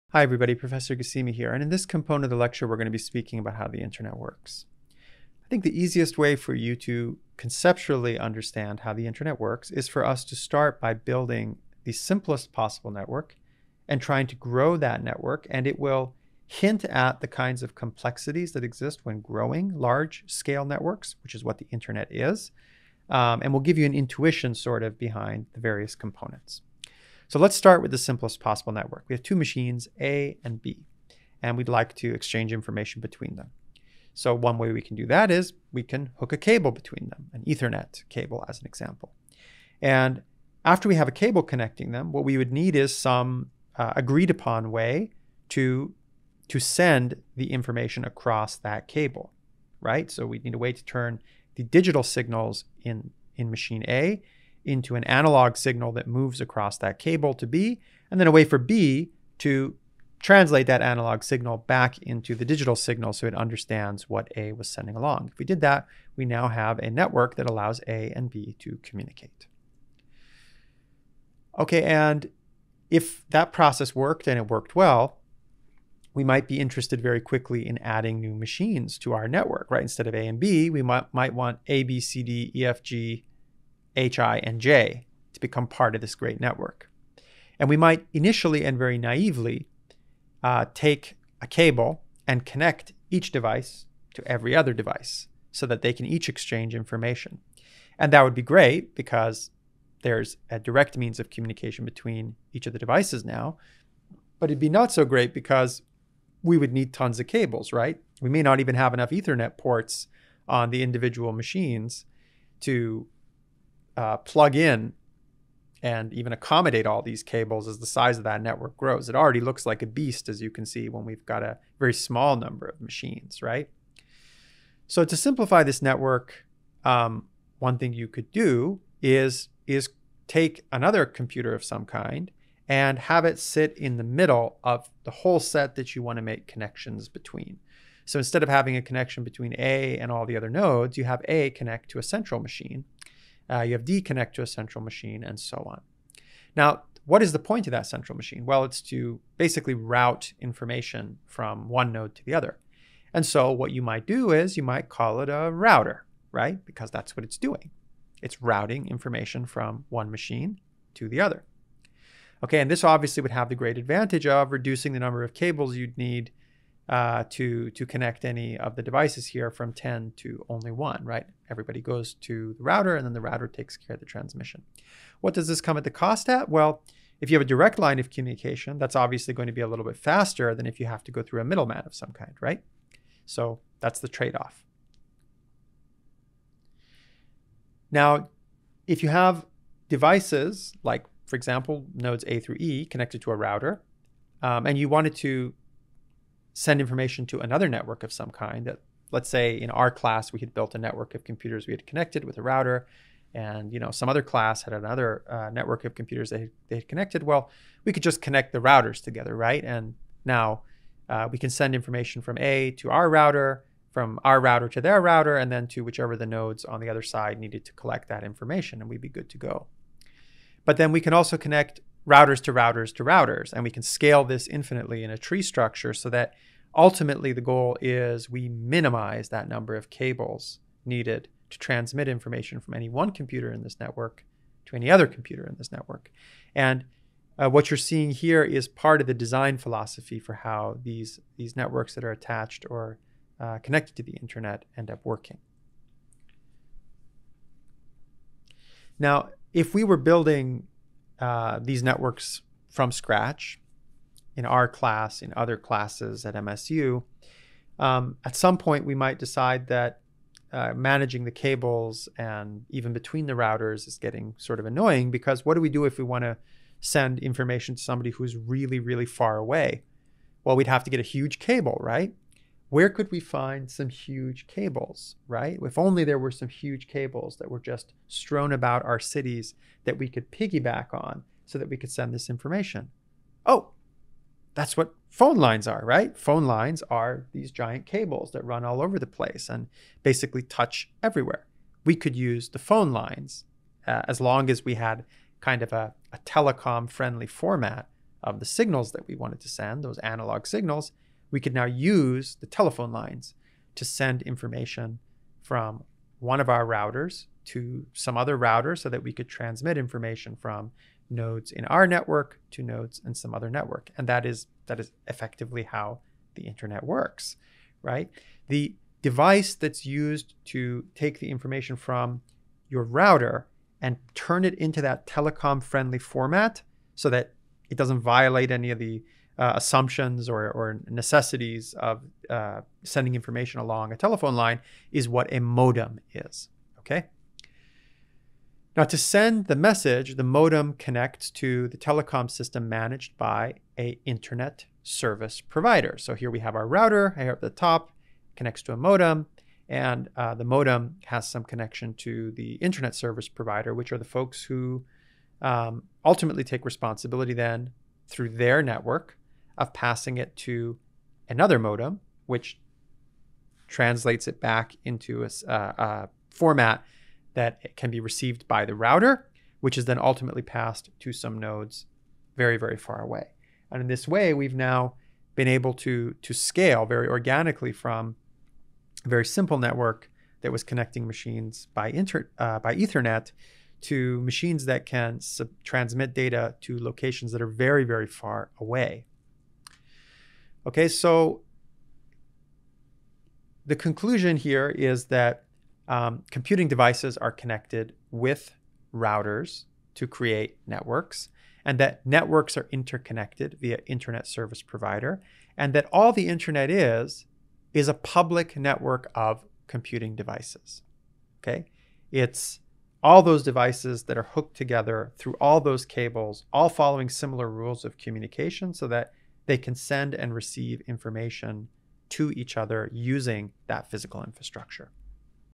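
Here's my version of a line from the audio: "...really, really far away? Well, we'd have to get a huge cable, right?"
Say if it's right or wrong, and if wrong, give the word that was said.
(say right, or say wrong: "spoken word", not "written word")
right.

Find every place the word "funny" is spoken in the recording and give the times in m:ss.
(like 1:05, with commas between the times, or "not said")
not said.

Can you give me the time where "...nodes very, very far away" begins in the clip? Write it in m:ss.
6:11.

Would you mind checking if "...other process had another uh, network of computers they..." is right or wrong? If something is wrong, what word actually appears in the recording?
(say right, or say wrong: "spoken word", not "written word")
wrong: "class", not "process".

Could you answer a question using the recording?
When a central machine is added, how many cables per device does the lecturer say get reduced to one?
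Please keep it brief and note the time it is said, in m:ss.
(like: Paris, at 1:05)
10, at 2:49.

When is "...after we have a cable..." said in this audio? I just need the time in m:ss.
0:40.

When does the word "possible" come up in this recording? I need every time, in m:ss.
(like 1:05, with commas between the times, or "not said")
0:12, 0:28.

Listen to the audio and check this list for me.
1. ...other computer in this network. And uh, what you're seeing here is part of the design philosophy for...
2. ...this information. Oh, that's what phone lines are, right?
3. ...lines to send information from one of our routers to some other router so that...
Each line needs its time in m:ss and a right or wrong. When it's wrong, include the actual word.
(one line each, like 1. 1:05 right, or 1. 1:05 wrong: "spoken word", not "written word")
1. 3:54 right
2. 4:42 right
3. 5:02 right.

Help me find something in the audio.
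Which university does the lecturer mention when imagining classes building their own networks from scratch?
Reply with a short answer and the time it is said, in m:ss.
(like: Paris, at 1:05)
MSU, at 4:16.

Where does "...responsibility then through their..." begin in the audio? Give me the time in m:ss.
5:56.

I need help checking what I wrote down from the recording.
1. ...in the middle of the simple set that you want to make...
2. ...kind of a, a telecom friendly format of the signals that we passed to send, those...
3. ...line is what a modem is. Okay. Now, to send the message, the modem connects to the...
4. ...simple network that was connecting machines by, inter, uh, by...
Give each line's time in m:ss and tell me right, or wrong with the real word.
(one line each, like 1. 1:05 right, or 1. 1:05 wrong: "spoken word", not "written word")
1. 2:13 wrong: "whole", not "simple"
2. 4:55 wrong: "wanted", not "passed"
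3. 5:34 right
4. 6:19 right.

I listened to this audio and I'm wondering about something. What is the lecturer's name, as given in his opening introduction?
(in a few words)
Professor Ghassemi.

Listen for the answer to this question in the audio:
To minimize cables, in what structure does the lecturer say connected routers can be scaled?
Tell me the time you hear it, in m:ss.
3:45.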